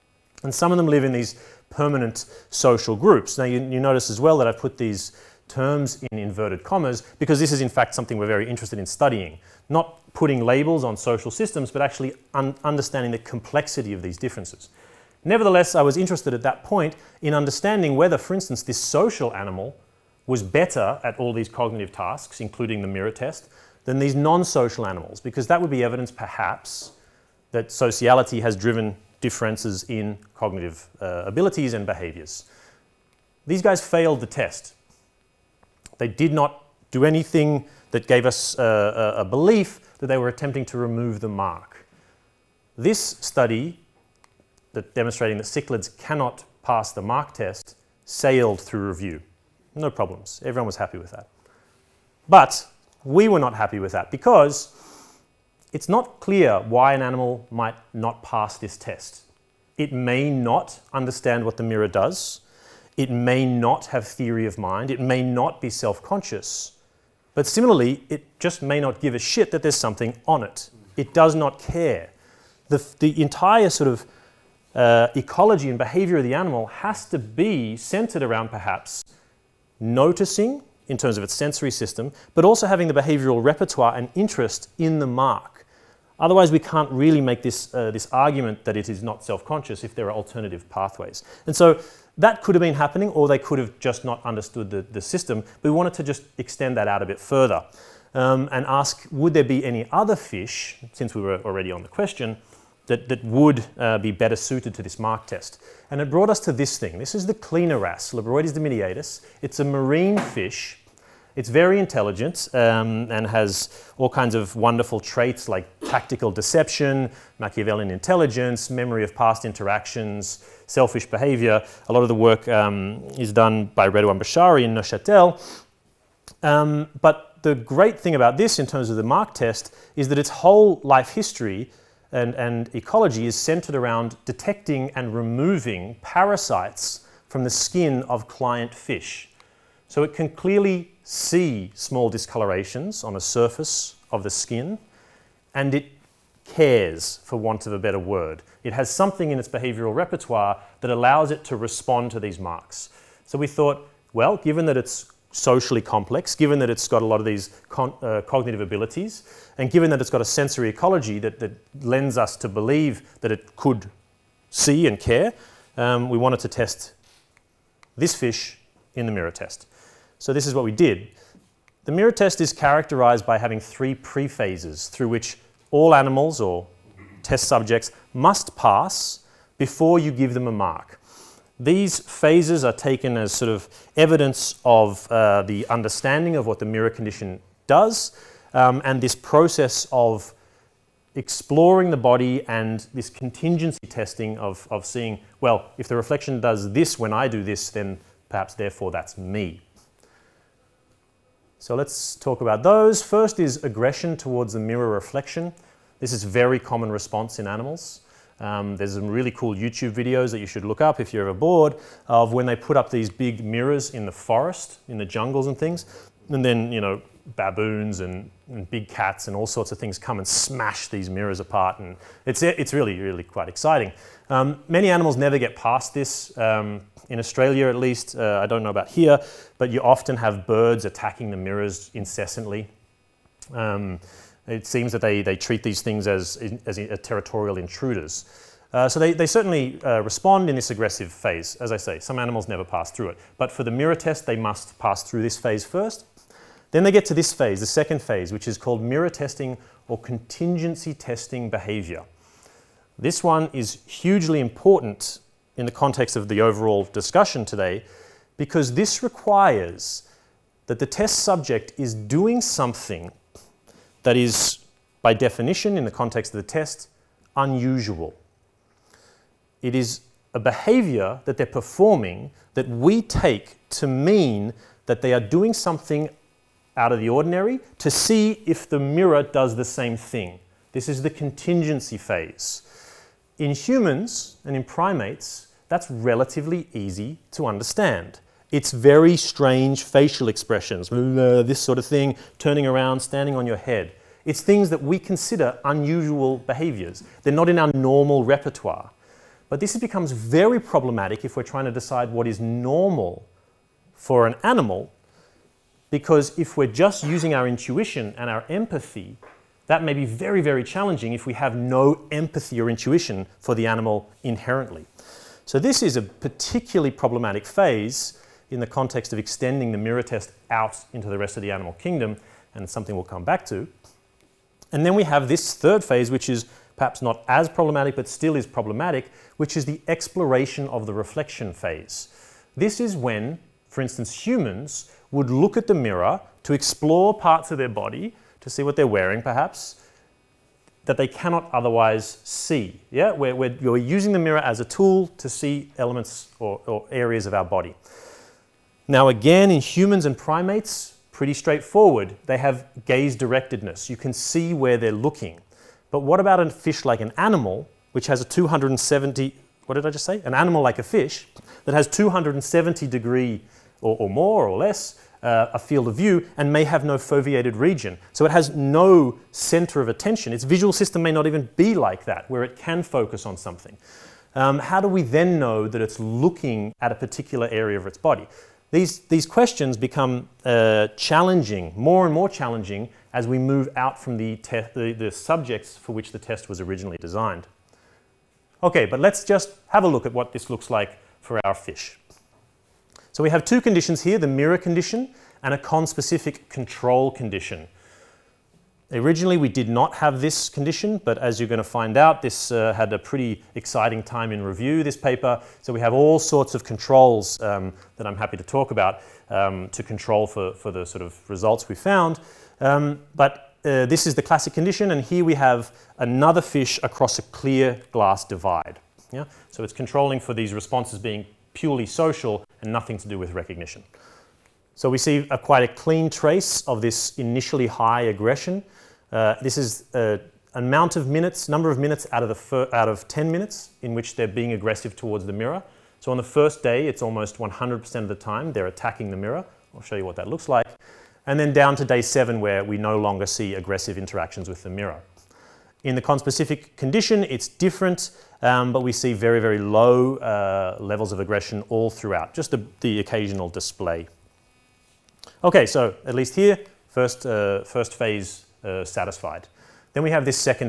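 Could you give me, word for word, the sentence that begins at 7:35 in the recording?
Okay, so at least here, first, uh, first phase uh, satisfied.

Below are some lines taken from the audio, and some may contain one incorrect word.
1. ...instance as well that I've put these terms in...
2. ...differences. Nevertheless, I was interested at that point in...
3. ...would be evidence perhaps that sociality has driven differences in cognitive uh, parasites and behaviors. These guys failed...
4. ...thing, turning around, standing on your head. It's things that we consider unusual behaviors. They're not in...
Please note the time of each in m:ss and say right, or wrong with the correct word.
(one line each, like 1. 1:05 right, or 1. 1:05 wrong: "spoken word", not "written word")
1. 0:03 wrong: "notice", not "instance"
2. 0:14 right
3. 0:25 wrong: "abilities", not "parasites"
4. 4:51 right.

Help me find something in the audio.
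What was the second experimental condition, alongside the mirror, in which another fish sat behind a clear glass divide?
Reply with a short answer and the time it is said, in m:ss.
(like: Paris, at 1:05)
conspecific control condition, at 6:35.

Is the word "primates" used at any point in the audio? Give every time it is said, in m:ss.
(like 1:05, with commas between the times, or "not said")
4:44, 5:50.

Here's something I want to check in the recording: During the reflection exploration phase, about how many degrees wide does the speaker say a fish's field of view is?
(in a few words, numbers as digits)
270 degrees.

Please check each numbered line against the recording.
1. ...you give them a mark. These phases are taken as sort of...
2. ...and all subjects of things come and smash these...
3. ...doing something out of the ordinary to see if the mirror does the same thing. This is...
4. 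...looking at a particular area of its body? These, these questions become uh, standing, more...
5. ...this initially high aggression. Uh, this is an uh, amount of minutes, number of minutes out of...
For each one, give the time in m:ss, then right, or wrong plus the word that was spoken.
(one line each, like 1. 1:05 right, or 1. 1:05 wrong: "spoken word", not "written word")
1. 2:59 right
2. 3:39 wrong: "sorts", not "subjects"
3. 4:35 right
4. 6:15 wrong: "challenging", not "standing"
5. 7:06 right.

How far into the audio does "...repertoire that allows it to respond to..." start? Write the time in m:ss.
2:29.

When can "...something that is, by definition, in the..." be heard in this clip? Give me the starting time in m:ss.
4:22.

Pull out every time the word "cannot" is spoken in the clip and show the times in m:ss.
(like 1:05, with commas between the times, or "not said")
0:45, 5:41.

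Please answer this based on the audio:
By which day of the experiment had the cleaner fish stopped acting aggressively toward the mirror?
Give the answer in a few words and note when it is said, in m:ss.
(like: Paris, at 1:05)
day 7, at 7:21.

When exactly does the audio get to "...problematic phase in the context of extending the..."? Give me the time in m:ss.
5:16.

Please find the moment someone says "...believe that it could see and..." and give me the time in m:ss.
2:42.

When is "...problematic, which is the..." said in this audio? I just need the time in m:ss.
5:28.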